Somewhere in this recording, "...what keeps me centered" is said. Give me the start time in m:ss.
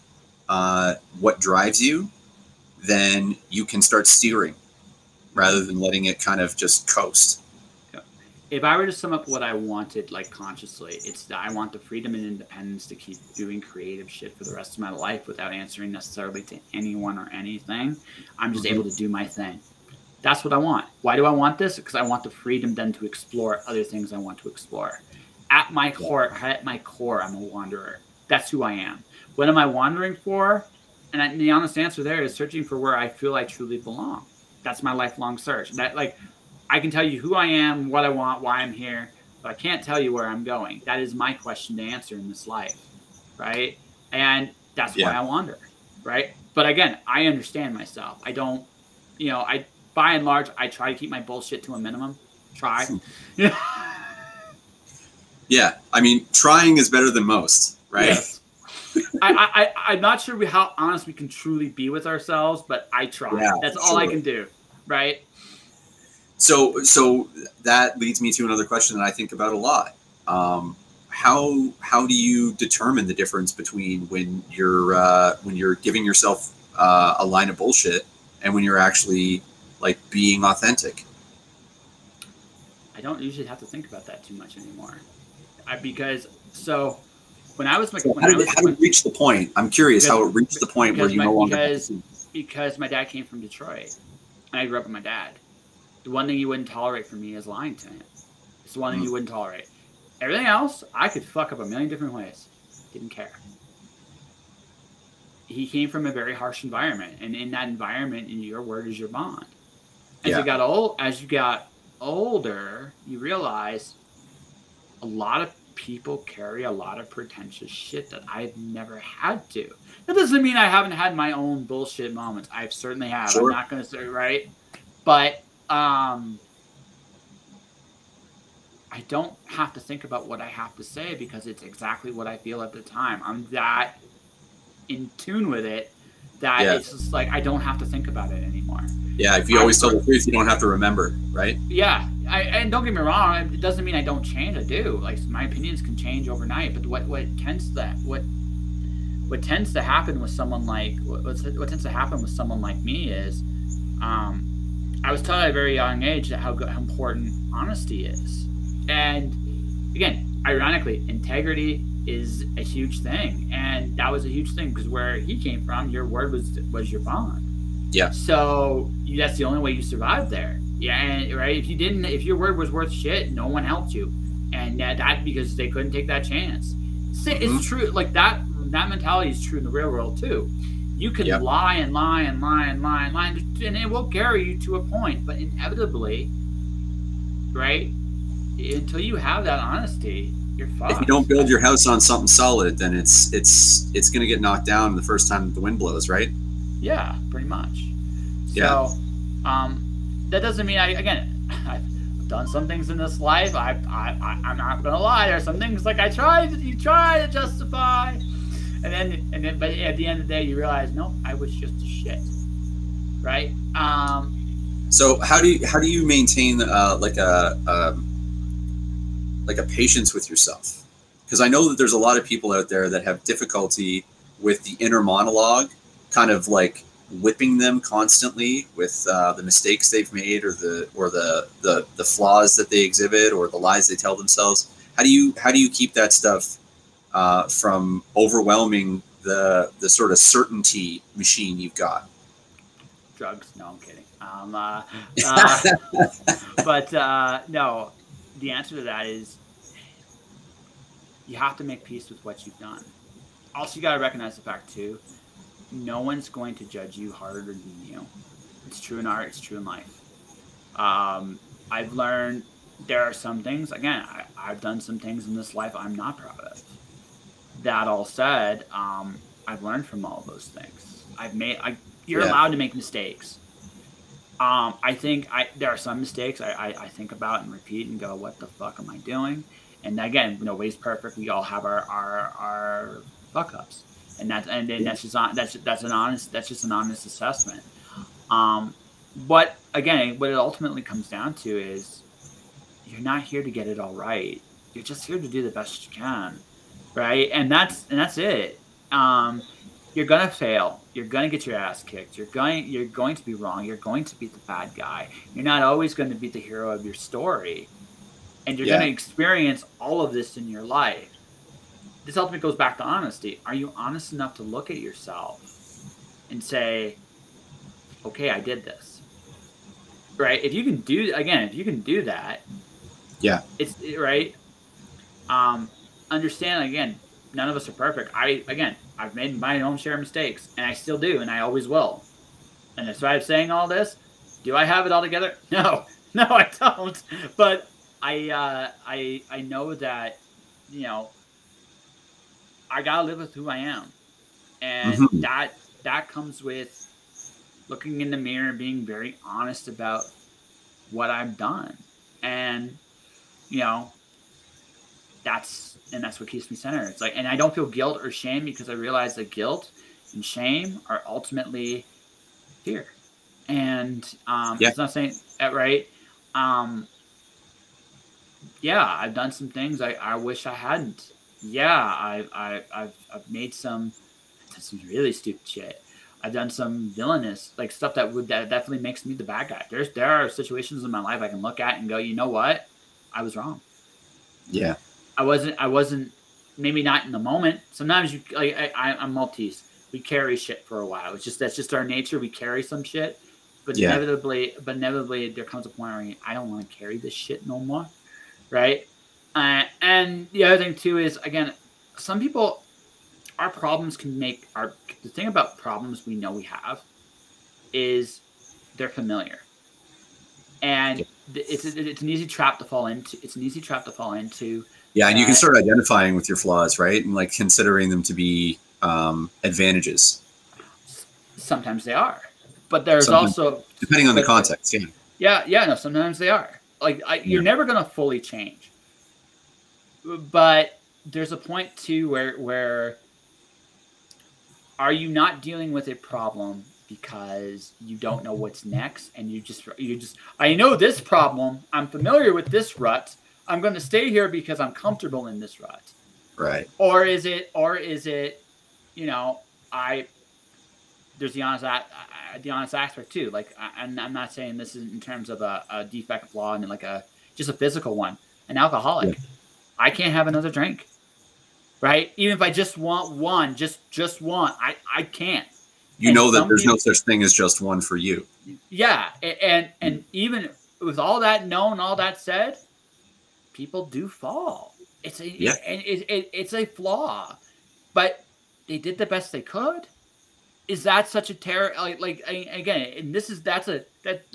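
5:56.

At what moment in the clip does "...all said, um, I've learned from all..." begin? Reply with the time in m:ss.
4:27.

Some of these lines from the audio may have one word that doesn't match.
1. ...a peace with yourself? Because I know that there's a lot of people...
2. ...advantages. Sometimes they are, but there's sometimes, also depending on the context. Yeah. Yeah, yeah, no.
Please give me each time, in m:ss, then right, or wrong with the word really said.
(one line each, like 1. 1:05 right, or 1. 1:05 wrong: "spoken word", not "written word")
1. 3:39 wrong: "patience", not "peace"
2. 6:59 right.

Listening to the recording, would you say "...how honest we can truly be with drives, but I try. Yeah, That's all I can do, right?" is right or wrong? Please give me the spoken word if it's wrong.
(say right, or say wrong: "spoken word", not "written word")
wrong: "ourselves", not "drives".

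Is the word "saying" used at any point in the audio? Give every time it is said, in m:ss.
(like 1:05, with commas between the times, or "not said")
5:33, 6:04, 7:34.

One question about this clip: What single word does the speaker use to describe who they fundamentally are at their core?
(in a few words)
wanderer.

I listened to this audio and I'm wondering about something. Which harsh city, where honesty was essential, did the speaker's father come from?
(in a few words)
Detroit.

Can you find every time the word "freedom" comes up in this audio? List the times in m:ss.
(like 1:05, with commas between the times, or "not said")
0:11, 0:22.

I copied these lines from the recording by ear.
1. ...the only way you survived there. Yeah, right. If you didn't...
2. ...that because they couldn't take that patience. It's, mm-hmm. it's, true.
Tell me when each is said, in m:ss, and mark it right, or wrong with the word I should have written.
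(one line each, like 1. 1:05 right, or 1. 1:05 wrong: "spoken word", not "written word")
1. 2:49 right
2. 2:54 wrong: "chance", not "patience".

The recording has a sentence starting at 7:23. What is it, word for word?
I'm going to stay here because I'm comfortable in this rut.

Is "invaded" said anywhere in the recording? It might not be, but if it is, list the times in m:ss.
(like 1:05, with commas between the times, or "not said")
not said.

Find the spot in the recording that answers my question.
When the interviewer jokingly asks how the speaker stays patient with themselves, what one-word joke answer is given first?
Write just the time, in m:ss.
4:03.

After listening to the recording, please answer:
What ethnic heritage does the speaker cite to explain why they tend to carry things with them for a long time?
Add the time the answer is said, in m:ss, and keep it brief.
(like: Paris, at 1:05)
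Maltese, at 6:29.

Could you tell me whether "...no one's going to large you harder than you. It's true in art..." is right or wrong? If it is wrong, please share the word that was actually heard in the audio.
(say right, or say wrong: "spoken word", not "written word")
wrong: "judge", not "large".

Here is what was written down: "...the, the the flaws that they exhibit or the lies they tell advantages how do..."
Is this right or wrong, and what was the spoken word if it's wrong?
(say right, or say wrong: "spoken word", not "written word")
wrong: "themselves", not "advantages".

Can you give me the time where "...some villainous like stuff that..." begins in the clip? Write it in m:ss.
6:16.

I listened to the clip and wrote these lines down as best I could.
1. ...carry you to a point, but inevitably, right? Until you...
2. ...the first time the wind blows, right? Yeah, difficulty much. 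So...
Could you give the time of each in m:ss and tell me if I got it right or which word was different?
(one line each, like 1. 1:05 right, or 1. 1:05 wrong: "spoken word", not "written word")
1. 3:04 right
2. 3:14 wrong: "pretty", not "difficulty".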